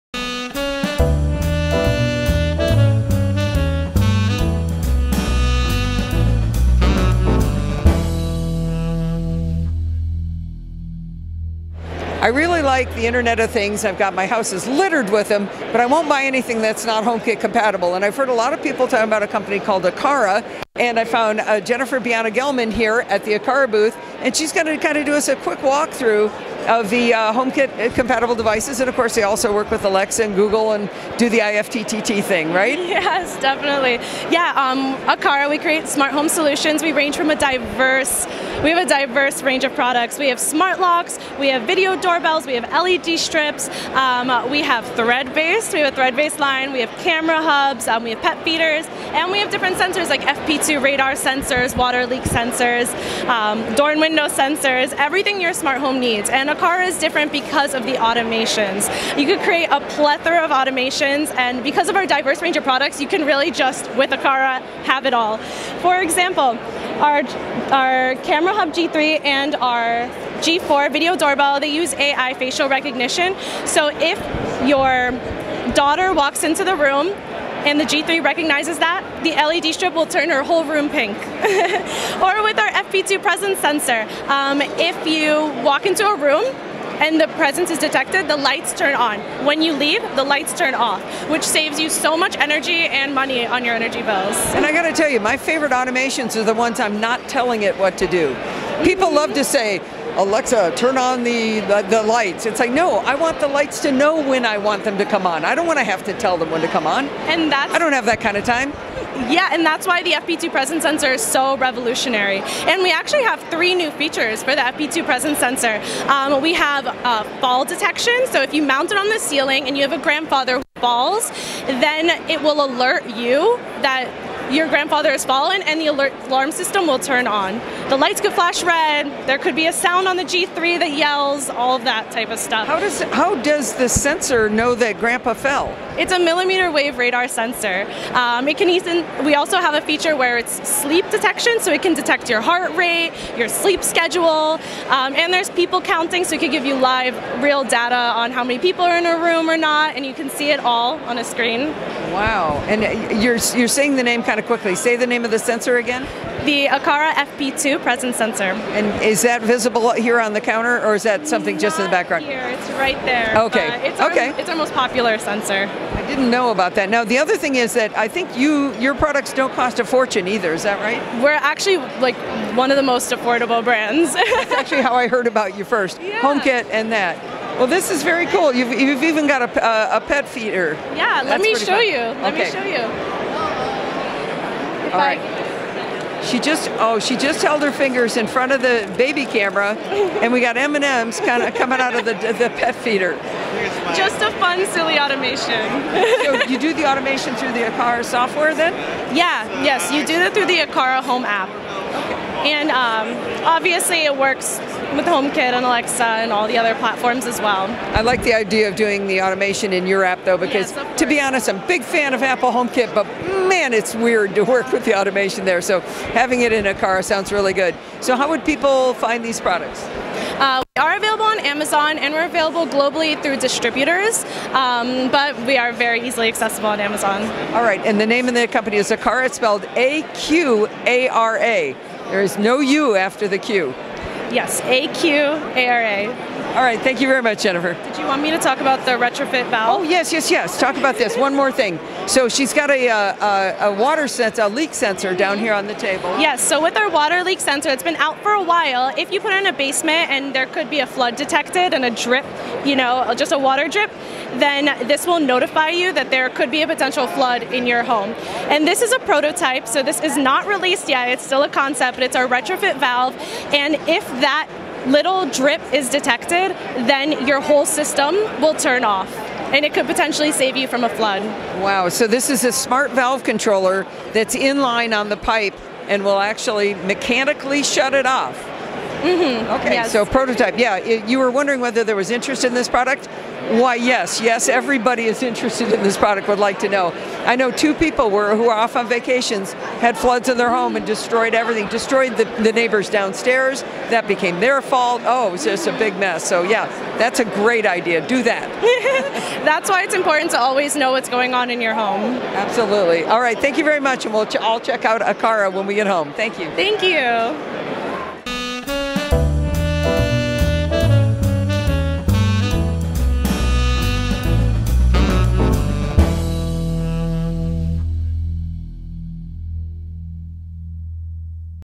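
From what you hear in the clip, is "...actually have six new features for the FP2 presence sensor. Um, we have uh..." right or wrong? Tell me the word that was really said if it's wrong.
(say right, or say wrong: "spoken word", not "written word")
wrong: "three", not "six".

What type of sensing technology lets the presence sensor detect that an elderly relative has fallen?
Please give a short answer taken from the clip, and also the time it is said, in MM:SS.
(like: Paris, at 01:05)
Millimeter wave radar, at 02:16.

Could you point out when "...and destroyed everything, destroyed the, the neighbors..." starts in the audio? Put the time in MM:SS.
04:50.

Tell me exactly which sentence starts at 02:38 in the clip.
And is that visible here on the counter, or is that something Not just in the background?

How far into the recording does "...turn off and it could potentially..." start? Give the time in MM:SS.
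04:28.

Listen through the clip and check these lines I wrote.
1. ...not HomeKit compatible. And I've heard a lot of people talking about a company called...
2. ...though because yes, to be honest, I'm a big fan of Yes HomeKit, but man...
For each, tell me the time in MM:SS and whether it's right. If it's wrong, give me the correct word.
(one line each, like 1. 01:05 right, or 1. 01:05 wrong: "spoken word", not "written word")
1. 00:16 right
2. 03:30 wrong: "Apple", not "Yes".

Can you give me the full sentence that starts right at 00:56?
And Aqara is different because of the automations.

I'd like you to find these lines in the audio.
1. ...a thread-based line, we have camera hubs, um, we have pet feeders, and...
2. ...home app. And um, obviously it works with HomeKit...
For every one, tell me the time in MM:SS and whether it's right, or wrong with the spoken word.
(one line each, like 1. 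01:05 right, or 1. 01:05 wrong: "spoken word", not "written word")
1. 00:45 right
2. 03:21 right.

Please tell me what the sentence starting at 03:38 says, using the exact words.
So how would people find these products?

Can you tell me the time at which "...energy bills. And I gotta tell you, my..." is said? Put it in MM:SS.
01:33.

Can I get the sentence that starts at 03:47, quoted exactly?
All right, and the name of the company is Aqara.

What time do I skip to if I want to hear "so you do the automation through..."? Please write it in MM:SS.
03:16.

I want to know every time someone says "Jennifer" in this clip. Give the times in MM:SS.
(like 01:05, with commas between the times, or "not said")
00:21, 03:57.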